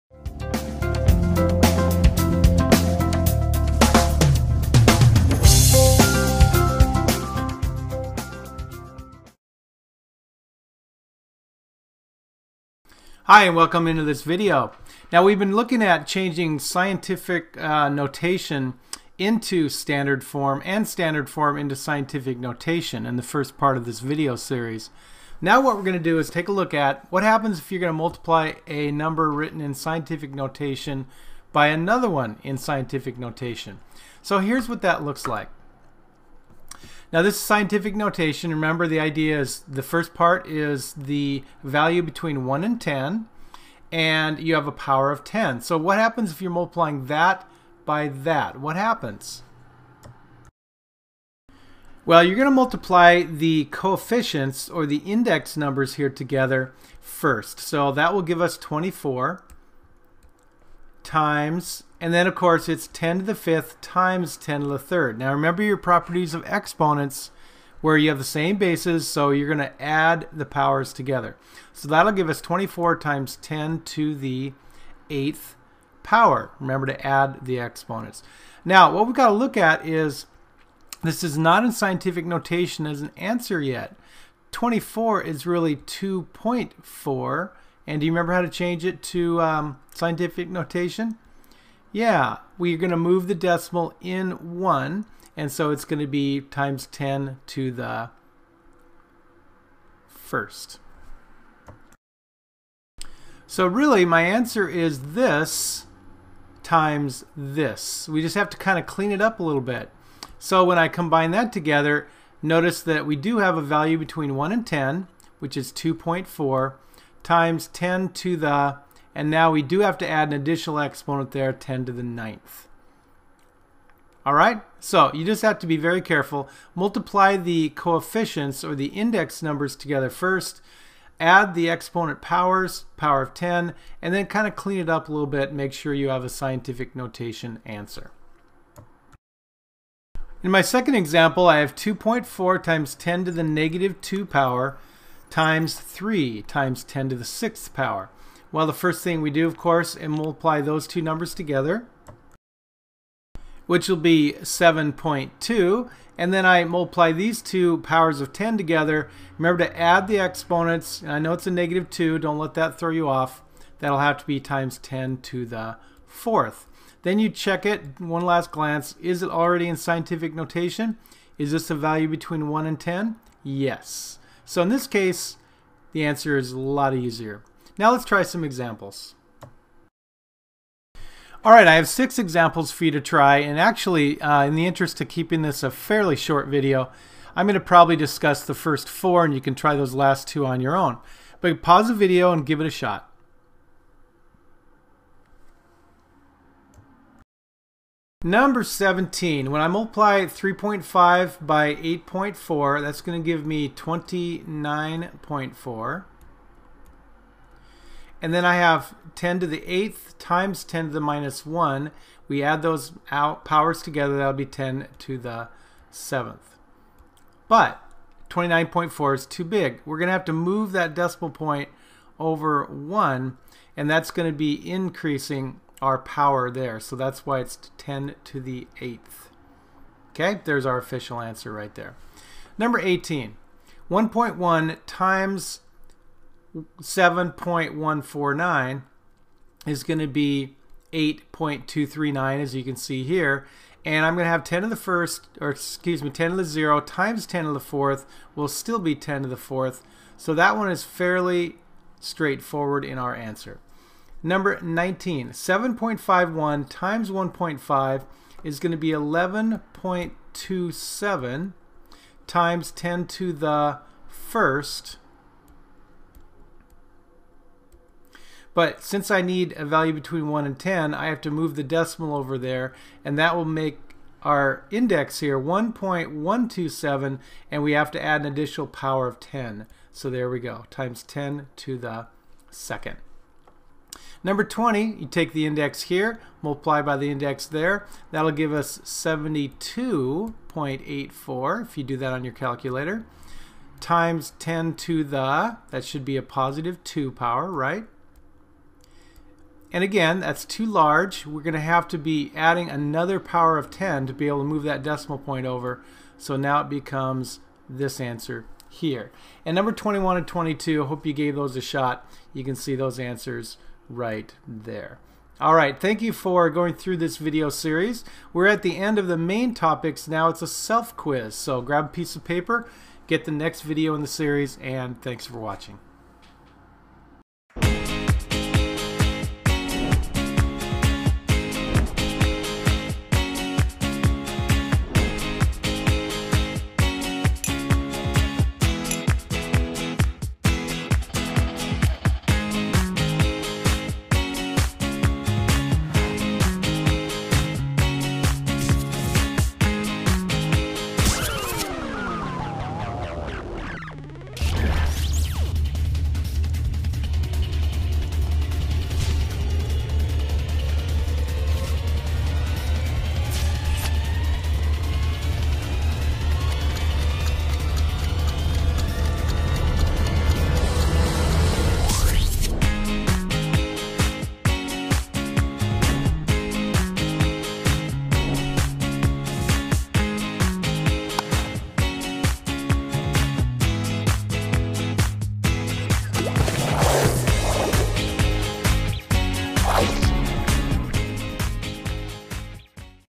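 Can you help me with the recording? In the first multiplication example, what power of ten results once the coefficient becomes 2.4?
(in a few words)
10 to the ninth.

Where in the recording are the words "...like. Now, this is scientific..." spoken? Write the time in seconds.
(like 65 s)
35 s.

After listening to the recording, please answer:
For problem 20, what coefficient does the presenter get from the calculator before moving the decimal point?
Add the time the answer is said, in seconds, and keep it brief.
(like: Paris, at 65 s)
72.84, at 288 s.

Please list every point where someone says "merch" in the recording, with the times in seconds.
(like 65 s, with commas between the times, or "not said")
not said.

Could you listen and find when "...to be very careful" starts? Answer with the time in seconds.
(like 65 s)
125 s.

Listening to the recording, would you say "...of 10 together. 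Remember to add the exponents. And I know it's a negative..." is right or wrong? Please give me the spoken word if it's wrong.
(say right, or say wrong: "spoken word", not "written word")
right.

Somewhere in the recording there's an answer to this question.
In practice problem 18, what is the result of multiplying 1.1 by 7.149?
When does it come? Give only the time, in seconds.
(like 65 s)
240 s.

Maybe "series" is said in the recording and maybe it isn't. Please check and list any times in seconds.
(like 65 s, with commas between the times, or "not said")
24 s, 317 s, 324 s.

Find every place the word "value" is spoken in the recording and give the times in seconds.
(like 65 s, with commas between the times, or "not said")
41 s, 113 s, 171 s, 269 s.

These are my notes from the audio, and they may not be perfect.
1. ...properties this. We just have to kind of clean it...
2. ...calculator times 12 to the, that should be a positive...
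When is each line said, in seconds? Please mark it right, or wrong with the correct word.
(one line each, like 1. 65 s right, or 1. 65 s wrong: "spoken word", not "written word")
1. 106 s wrong: "times", not "properties"
2. 292 s wrong: "10", not "12".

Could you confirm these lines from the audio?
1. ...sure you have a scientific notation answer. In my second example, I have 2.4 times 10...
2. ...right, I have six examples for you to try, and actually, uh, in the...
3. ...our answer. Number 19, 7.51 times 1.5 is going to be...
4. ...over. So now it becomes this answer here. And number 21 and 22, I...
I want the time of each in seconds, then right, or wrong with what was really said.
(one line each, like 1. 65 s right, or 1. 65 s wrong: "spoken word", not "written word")
1. 135 s right
2. 181 s right
3. 252 s right
4. 305 s right.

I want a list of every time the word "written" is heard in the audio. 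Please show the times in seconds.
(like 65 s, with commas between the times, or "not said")
29 s.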